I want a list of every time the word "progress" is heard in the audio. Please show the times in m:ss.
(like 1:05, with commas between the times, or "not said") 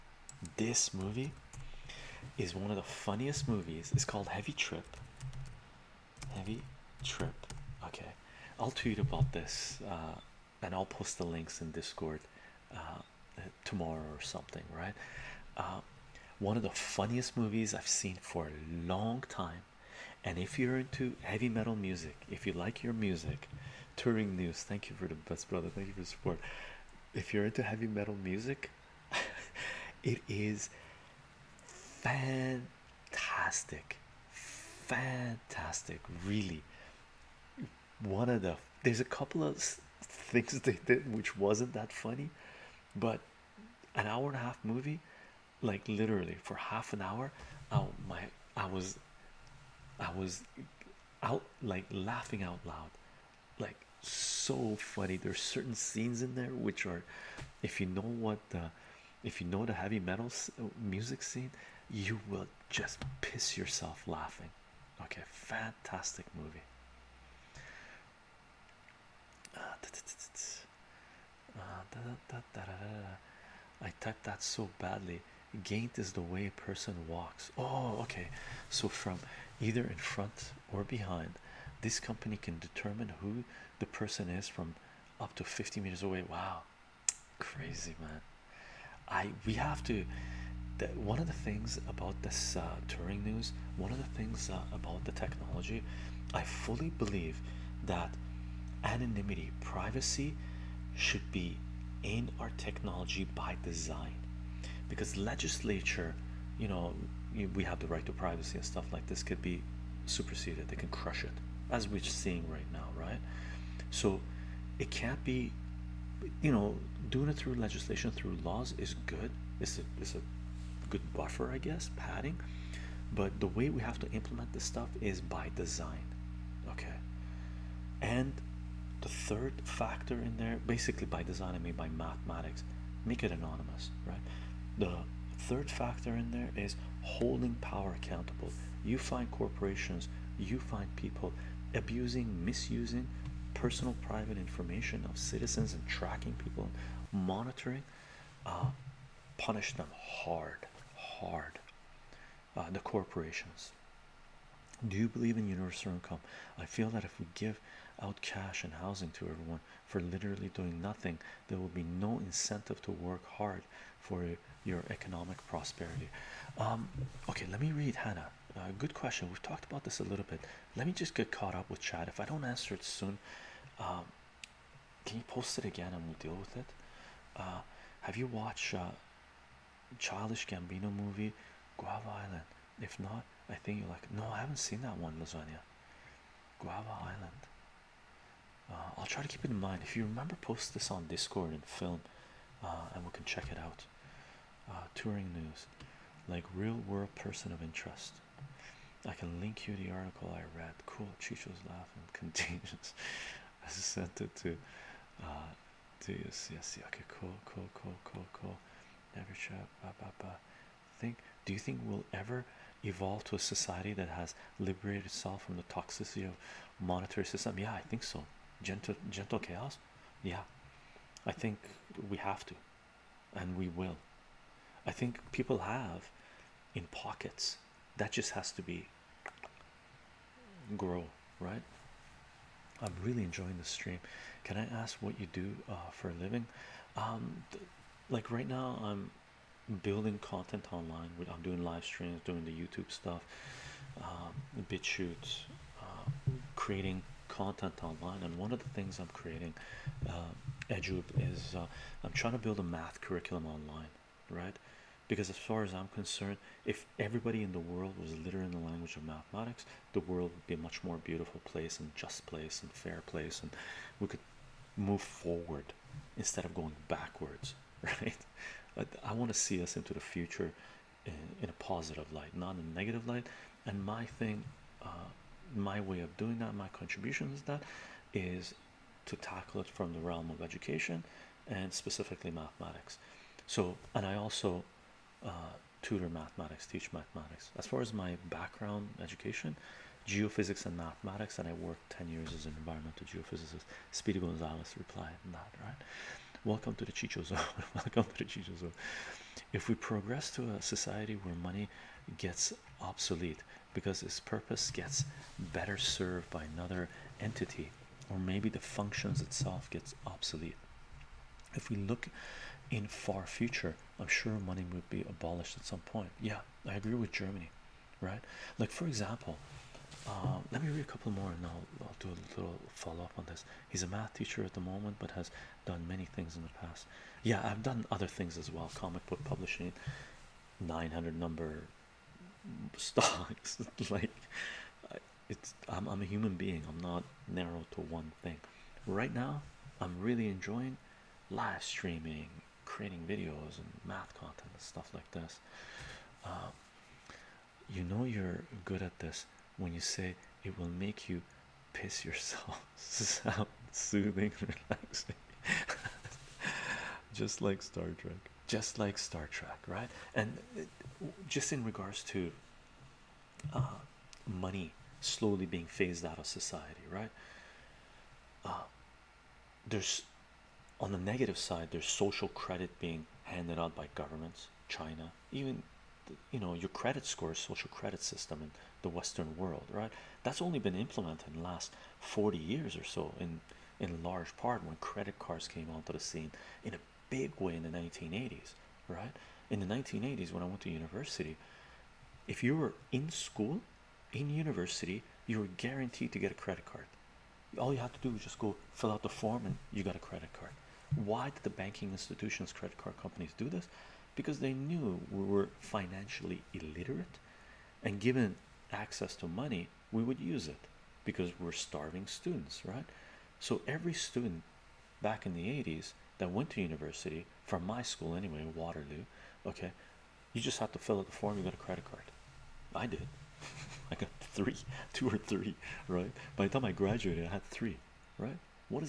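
4:59.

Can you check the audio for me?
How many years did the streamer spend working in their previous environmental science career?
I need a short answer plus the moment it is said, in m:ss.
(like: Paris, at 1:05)
10 years, at 4:51.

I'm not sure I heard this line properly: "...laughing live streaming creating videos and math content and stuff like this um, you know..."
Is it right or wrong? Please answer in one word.
wrong.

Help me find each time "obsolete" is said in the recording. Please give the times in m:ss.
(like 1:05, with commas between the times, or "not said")
5:02, 5:10.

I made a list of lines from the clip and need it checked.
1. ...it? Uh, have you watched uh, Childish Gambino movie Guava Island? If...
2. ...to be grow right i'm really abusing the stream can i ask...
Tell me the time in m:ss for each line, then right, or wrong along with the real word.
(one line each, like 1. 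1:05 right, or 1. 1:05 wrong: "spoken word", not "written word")
1. 2:56 right
2. 3:48 wrong: "enjoying", not "abusing".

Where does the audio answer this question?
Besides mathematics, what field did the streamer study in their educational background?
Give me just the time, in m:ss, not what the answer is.
4:50.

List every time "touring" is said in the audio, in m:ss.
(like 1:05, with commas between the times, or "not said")
0:23, 1:32, 3:14.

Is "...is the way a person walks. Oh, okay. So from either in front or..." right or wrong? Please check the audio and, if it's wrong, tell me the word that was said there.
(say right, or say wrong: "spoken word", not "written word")
right.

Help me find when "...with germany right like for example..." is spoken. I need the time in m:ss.
5:16.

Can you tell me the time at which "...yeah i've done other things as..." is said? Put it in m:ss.
5:27.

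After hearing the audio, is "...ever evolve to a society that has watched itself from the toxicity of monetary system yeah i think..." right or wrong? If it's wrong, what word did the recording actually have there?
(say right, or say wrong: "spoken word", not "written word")
wrong: "liberated", not "watched".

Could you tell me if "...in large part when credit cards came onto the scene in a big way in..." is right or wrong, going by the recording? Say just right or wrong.
right.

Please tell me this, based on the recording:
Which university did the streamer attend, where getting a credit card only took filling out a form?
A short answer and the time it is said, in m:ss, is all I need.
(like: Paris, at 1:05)
Waterloo, at 6:58.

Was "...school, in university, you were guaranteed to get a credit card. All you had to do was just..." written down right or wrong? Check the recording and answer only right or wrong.
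right.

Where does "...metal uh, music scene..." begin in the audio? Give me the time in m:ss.
0:59.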